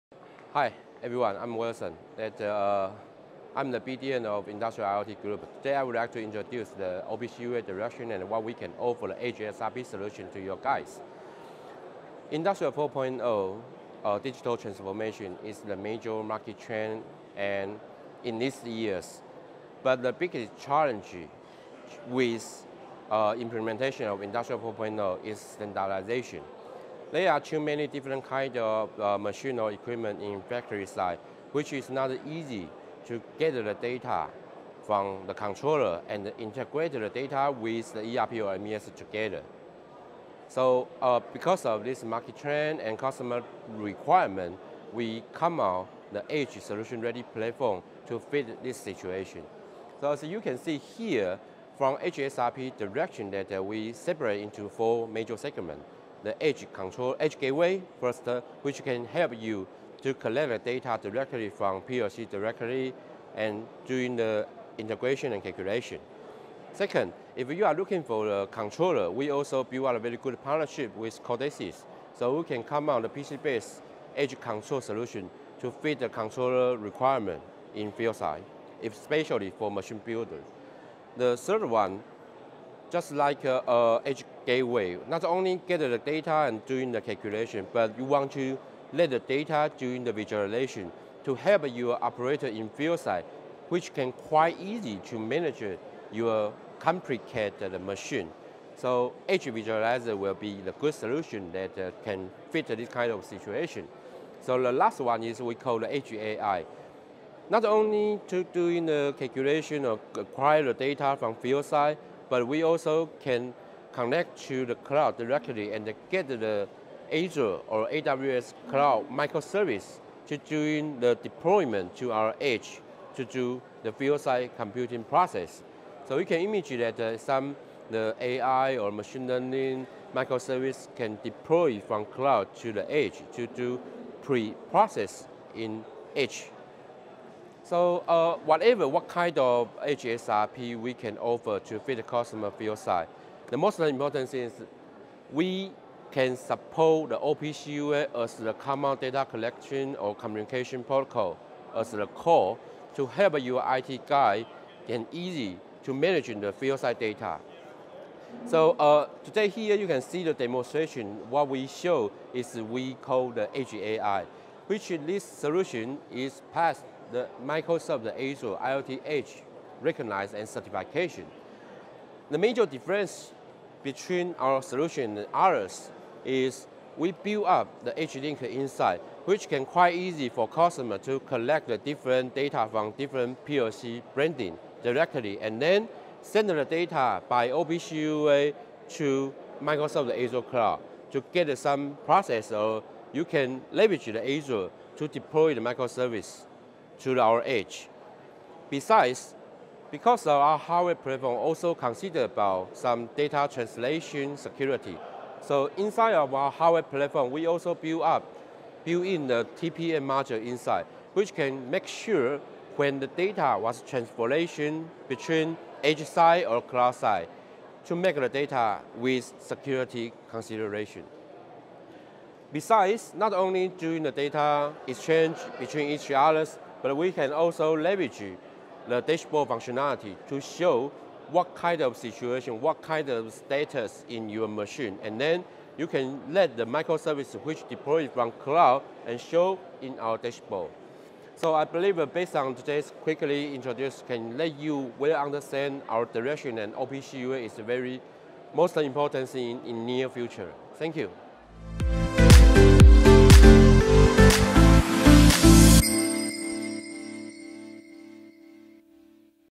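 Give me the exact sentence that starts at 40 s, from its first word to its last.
So uh, because of this market trend and customer requirement, we come out the edge solution ready platform to fit this situation.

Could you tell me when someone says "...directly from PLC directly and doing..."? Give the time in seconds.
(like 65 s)
61 s.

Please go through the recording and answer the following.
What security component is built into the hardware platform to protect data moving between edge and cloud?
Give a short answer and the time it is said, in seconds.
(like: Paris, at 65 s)
TPM module, at 209 s.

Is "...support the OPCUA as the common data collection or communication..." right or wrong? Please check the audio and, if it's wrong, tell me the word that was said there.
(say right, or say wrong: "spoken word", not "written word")
right.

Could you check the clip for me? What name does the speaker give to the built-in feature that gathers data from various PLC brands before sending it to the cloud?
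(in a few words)
Edge Link.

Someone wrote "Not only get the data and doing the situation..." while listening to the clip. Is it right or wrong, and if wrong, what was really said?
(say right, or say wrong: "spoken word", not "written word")
wrong: "calculation", not "situation".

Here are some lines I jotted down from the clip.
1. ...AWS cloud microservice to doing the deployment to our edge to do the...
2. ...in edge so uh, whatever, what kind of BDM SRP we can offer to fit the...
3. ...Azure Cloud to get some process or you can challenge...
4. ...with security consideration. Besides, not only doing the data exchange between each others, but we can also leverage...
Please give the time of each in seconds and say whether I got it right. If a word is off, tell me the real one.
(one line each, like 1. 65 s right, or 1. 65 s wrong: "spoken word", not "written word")
1. 117 s right
2. 135 s wrong: "Edge", not "BDM"
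3. 190 s wrong: "leverage", not "challenge"
4. 218 s right.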